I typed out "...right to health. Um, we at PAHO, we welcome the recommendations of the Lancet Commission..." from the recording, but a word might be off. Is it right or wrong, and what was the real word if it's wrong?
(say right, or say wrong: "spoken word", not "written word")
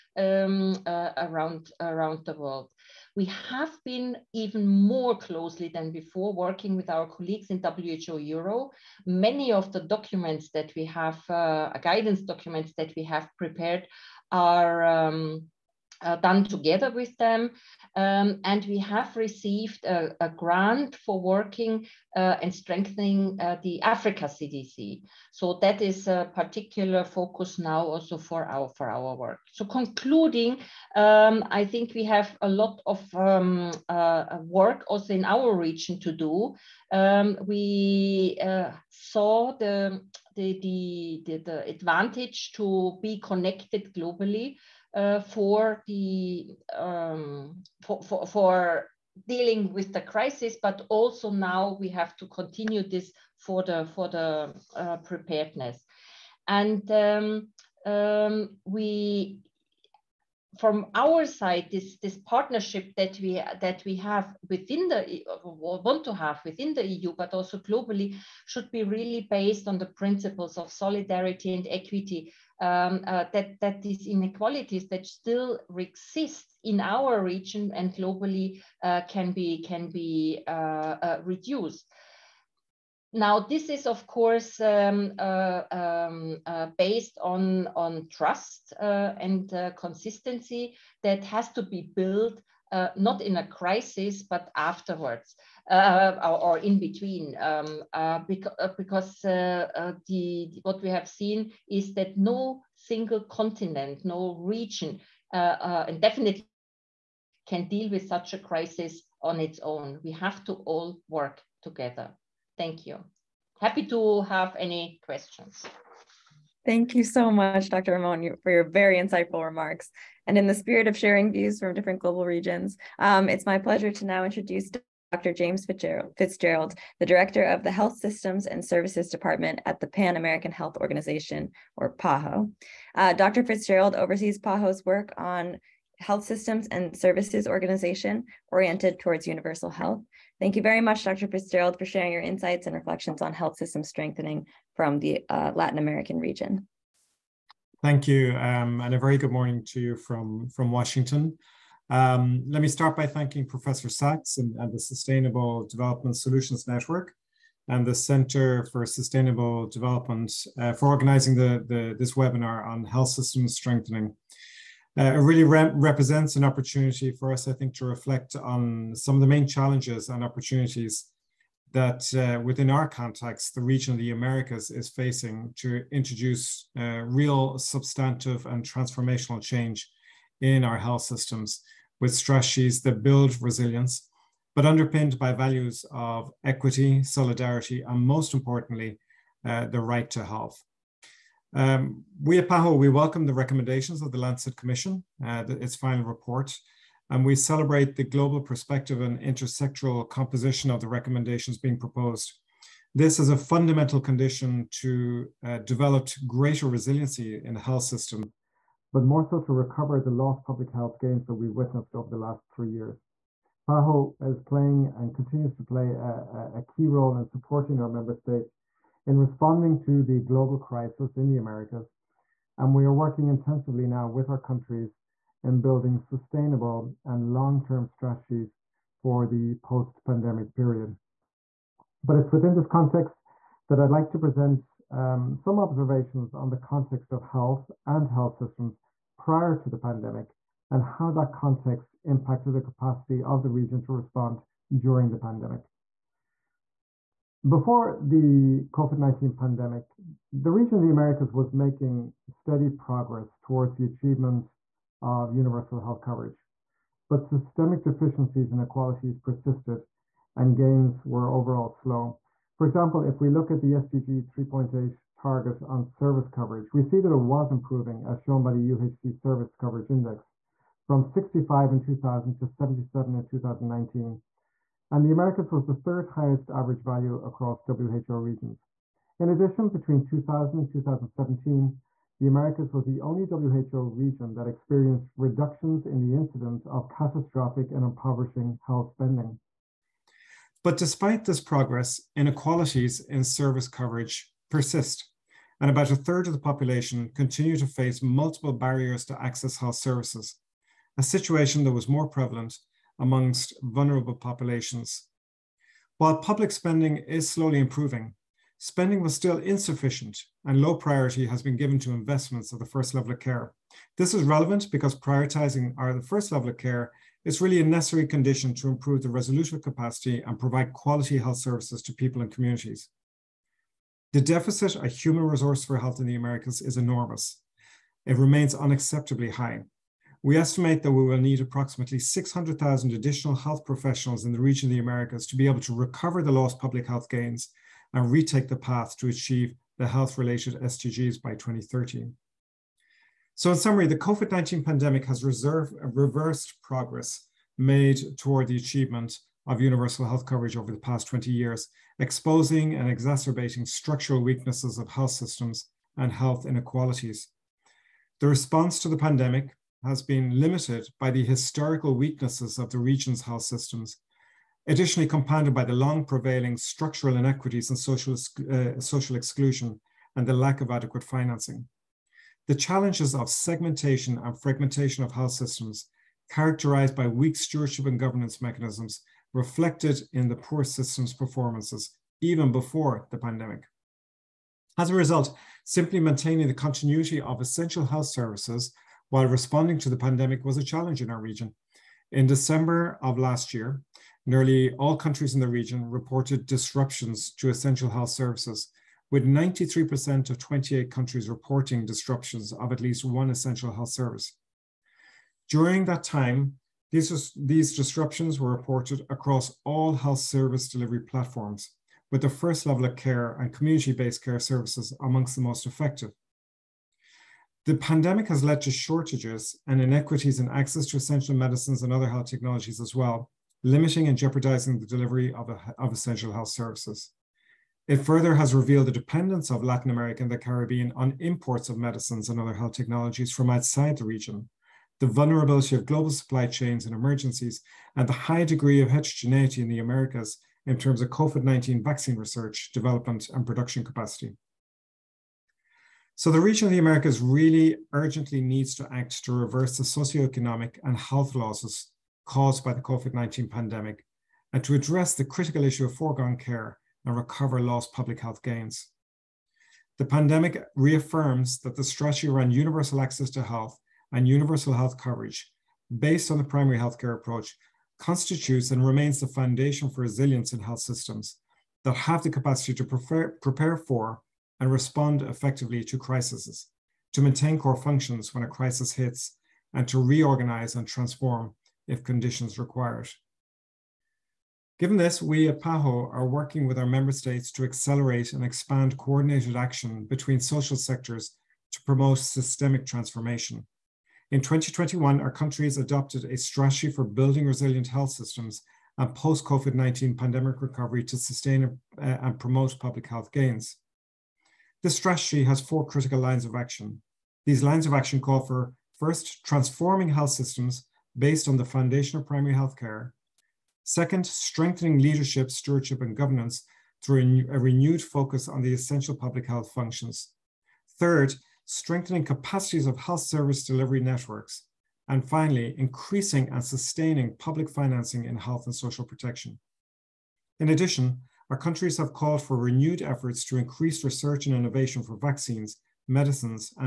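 right.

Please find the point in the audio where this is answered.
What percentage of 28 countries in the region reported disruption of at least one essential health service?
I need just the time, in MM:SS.
06:39.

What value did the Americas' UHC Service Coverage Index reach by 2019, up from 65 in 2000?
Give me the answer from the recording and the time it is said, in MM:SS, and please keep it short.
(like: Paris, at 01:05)
77, at 04:32.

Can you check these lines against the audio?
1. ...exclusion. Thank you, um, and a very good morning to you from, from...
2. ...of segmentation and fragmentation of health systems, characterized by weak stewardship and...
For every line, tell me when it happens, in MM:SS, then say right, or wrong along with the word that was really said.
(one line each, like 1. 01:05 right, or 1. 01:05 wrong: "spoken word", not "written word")
1. 02:26 wrong: "region", not "exclusion"
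2. 06:13 right.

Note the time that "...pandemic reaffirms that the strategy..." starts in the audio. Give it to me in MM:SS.
07:40.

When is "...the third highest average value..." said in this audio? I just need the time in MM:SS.
04:35.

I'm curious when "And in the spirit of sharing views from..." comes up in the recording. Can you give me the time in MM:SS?
02:00.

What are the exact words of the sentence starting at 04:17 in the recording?
But systemic deficiencies and inequalities persisted, and gains were overall slow.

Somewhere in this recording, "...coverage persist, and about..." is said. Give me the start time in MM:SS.
04:53.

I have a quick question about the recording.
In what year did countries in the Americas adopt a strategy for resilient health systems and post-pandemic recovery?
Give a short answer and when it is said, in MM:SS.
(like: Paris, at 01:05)
2021, at 08:14.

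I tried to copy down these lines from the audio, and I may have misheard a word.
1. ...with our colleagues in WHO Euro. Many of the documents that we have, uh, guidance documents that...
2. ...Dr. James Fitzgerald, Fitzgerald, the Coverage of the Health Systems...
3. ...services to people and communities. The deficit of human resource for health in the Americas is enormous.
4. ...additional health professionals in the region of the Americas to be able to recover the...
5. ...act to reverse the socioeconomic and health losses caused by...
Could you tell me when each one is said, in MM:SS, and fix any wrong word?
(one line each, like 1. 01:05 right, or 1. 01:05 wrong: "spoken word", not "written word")
1. 00:06 right
2. 02:05 wrong: "Director", not "Coverage"
3. 05:21 right
4. 05:32 right
5. 07:28 right.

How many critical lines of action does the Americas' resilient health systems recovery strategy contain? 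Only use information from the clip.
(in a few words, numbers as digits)
4.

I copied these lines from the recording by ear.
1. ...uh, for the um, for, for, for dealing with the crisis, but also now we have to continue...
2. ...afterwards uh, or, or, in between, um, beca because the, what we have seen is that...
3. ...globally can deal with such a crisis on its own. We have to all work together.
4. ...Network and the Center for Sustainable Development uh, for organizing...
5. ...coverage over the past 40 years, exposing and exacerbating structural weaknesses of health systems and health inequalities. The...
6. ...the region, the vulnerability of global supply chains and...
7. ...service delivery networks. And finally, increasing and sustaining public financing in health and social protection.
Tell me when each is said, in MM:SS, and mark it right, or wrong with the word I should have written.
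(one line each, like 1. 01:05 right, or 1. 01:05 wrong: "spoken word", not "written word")
1. 00:44 right
2. 01:34 right
3. 01:46 wrong: "definitely", not "globally"
4. 02:36 right
5. 05:50 wrong: "20", not "40"
6. 07:13 right
7. 08:43 right.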